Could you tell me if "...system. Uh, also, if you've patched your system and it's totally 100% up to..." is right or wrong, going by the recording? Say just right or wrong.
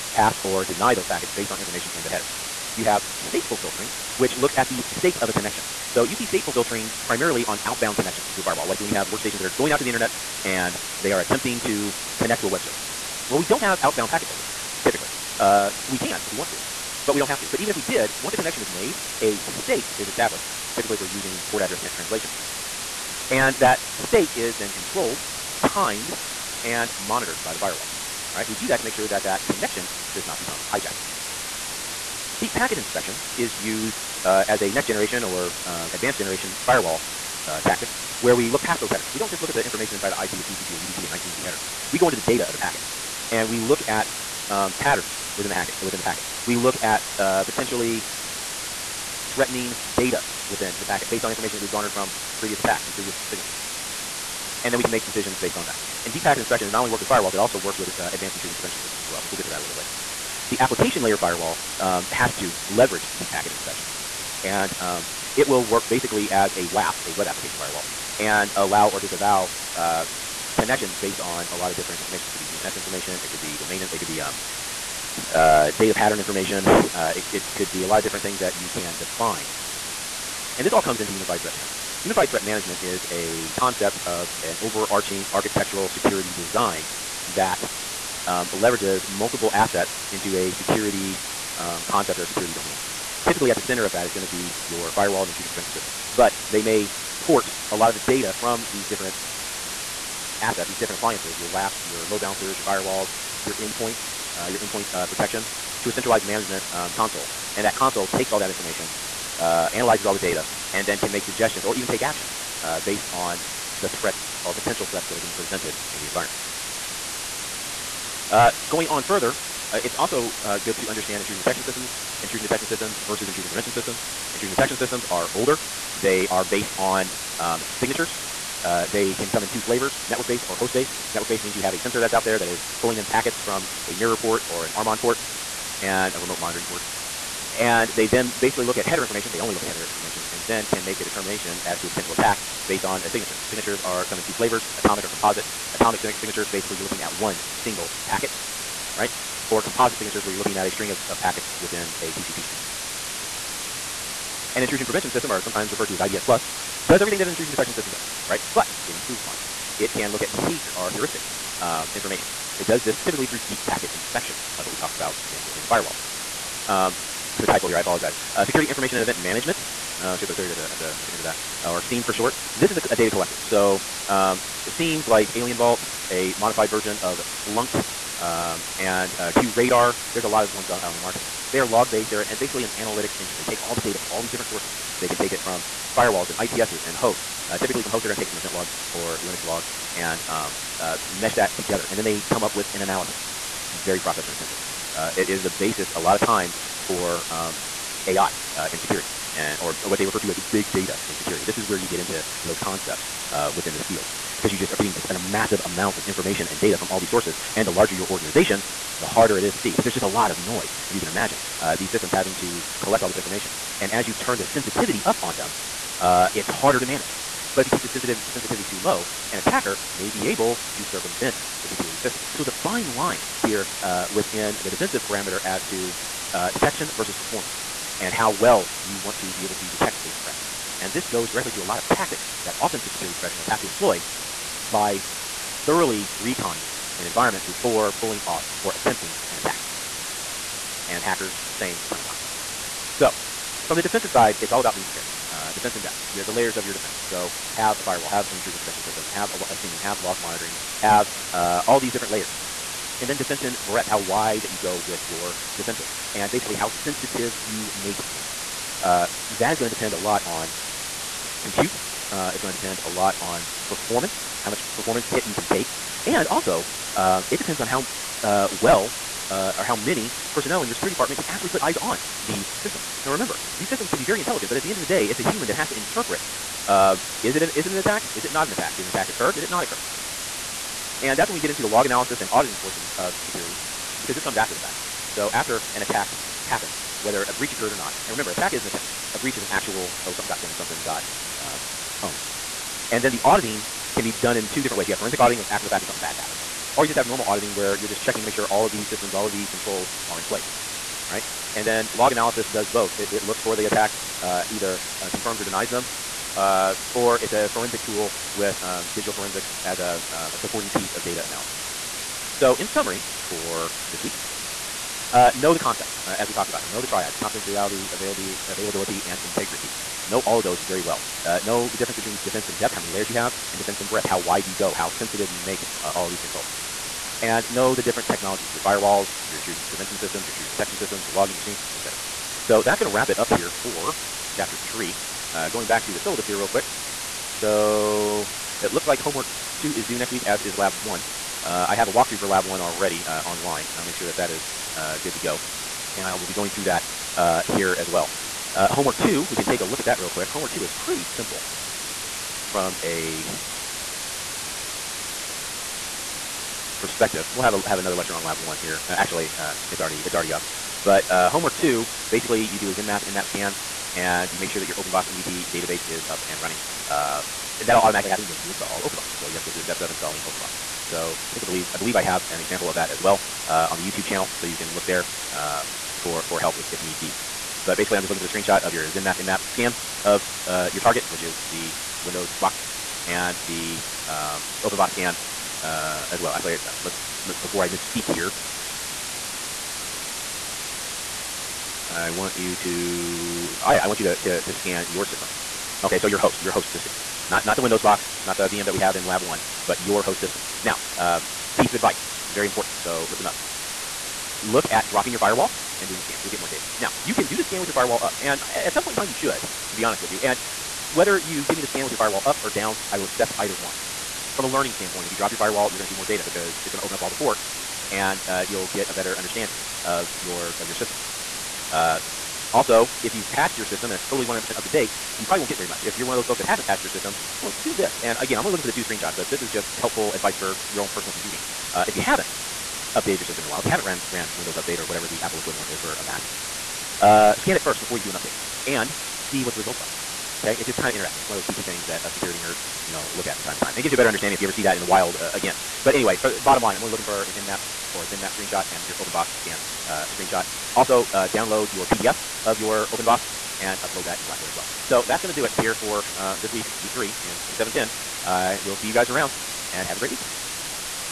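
right.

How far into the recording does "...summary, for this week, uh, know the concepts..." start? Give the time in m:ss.
5:12.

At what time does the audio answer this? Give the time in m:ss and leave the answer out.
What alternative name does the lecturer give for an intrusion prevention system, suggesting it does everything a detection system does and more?
2:35.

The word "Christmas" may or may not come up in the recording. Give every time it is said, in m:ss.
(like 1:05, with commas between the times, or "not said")
not said.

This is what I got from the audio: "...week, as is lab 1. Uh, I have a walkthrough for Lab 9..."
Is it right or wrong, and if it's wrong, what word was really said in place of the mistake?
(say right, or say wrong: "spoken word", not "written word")
wrong: "1", not "9".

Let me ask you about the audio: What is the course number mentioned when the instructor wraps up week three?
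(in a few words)
4710.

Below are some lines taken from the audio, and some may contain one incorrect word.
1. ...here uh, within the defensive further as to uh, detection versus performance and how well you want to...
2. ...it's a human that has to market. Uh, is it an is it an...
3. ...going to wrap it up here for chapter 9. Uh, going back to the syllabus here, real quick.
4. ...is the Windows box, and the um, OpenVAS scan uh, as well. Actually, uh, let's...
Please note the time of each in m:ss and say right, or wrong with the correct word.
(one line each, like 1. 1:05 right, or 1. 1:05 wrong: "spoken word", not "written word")
1. 3:43 wrong: "parameter", not "further"
2. 4:35 wrong: "interpret", not "market"
3. 5:32 wrong: "3", not "9"
4. 6:21 right.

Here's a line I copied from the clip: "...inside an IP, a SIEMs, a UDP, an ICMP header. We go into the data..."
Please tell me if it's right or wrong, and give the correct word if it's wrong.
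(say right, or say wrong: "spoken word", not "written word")
wrong: "TCP", not "SIEMs".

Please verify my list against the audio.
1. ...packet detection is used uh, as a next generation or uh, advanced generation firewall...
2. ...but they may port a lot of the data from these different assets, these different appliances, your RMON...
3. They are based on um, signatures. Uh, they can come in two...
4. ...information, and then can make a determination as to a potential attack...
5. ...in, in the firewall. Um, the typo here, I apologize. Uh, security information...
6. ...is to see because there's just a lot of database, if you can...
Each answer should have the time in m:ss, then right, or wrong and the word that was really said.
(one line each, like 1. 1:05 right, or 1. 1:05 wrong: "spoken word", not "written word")
1. 0:32 wrong: "inspection", not "detection"
2. 1:36 wrong: "WAFs", not "RMON"
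3. 2:06 right
4. 2:19 right
5. 2:45 right
6. 3:29 wrong: "noise", not "database".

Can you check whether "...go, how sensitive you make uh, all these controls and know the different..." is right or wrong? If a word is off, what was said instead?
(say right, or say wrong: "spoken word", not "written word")
right.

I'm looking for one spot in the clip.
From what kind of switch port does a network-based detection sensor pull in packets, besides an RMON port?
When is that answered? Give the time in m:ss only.
2:13.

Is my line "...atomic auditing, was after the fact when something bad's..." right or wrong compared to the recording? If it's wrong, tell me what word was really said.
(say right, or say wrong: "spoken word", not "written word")
wrong: "forensic", not "atomic".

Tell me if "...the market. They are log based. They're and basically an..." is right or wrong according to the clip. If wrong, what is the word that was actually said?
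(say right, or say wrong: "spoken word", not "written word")
right.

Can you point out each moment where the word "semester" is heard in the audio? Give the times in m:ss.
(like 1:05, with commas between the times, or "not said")
not said.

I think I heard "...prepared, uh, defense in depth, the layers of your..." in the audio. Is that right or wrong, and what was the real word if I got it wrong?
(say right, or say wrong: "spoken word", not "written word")
right.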